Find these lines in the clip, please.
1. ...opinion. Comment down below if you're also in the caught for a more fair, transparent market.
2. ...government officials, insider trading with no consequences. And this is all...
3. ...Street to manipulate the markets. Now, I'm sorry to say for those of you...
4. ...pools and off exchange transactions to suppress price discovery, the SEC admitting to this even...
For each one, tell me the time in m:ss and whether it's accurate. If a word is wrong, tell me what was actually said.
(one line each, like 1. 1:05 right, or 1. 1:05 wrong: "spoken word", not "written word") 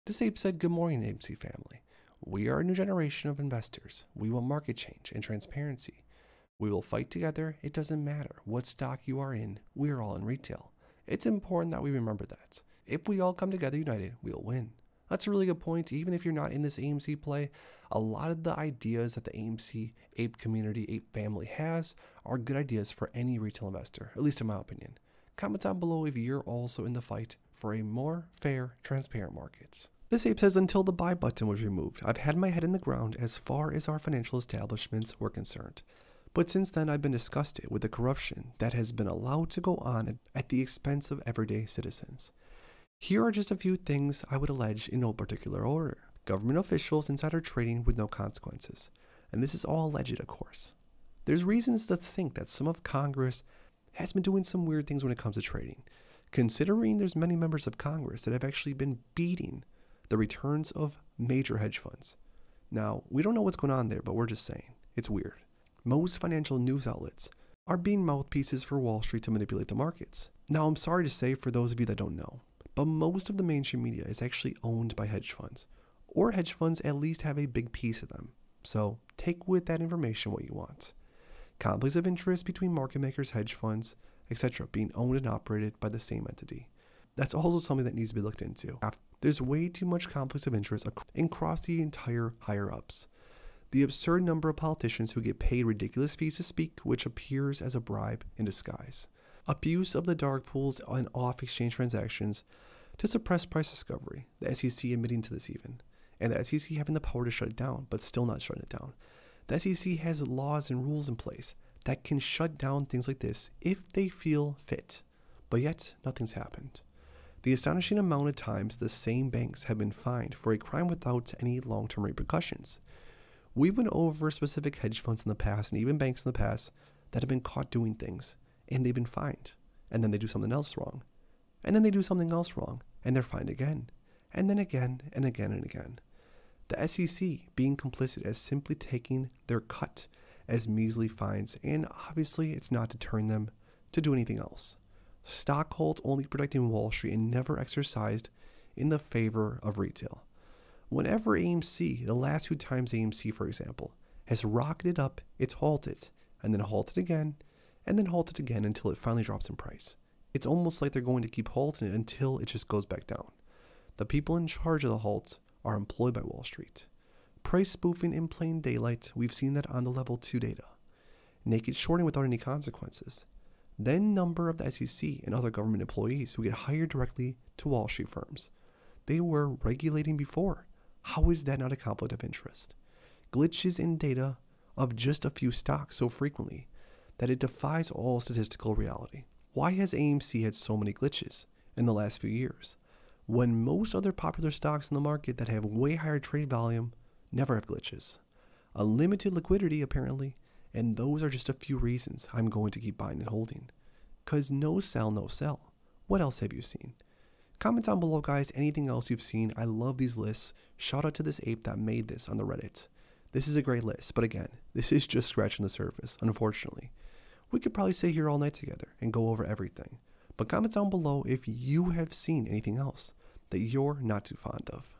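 1. 0:24 wrong: "fight", not "caught"
2. 0:46 right
3. 1:09 right
4. 1:40 right.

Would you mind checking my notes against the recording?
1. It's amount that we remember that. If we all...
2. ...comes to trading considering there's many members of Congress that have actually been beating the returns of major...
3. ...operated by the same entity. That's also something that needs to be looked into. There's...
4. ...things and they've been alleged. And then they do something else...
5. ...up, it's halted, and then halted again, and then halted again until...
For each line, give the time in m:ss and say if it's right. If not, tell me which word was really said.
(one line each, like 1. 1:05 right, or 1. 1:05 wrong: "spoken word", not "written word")
1. 0:11 wrong: "important", not "amount"
2. 0:55 right
3. 1:25 right
4. 2:07 wrong: "fined", not "alleged"
5. 2:34 right.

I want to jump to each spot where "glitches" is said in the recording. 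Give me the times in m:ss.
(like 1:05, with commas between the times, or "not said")
3:03, 3:10, 3:17.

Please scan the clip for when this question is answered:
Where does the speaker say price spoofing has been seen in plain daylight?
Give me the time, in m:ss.
2:49.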